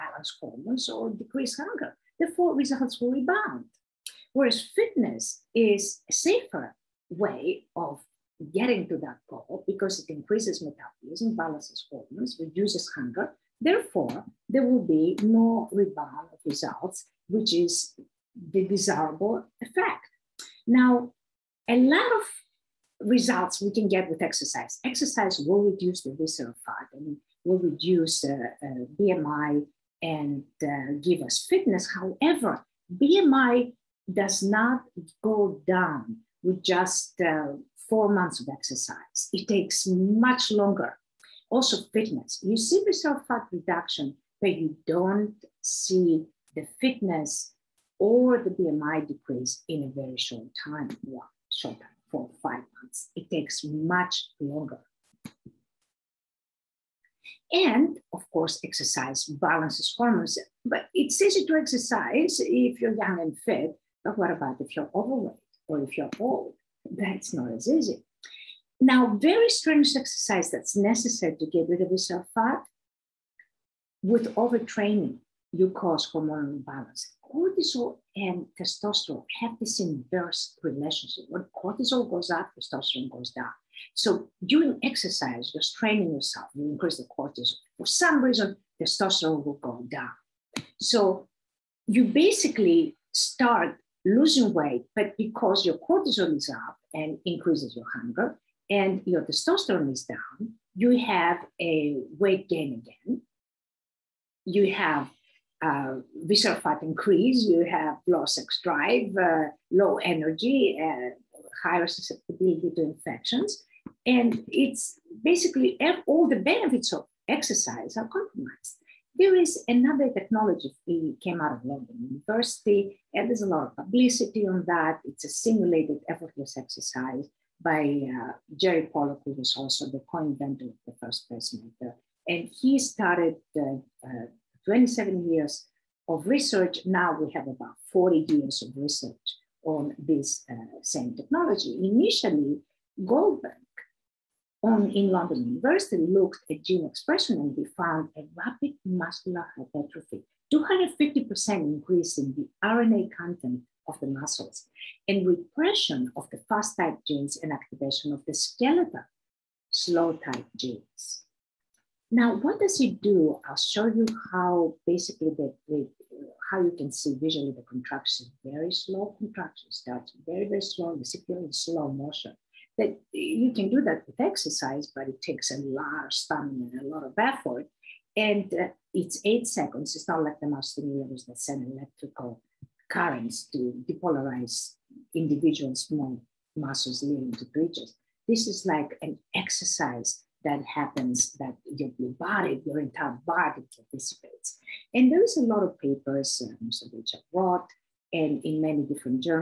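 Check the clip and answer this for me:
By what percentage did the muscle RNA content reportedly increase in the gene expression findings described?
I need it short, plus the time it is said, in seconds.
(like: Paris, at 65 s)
250%, at 150 s.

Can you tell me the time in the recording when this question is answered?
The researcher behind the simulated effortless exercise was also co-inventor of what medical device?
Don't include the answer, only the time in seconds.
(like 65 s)
130 s.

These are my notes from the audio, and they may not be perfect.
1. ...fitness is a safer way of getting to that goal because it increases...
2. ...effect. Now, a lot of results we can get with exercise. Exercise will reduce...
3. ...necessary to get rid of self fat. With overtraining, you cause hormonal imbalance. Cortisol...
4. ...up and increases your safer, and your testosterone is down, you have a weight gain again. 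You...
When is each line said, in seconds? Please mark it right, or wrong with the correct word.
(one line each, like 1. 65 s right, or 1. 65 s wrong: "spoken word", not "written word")
1. 4 s right
2. 19 s right
3. 70 s right
4. 96 s wrong: "hunger", not "safer".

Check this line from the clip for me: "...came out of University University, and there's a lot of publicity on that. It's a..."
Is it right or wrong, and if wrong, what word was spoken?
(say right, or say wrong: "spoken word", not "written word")
wrong: "London", not "University".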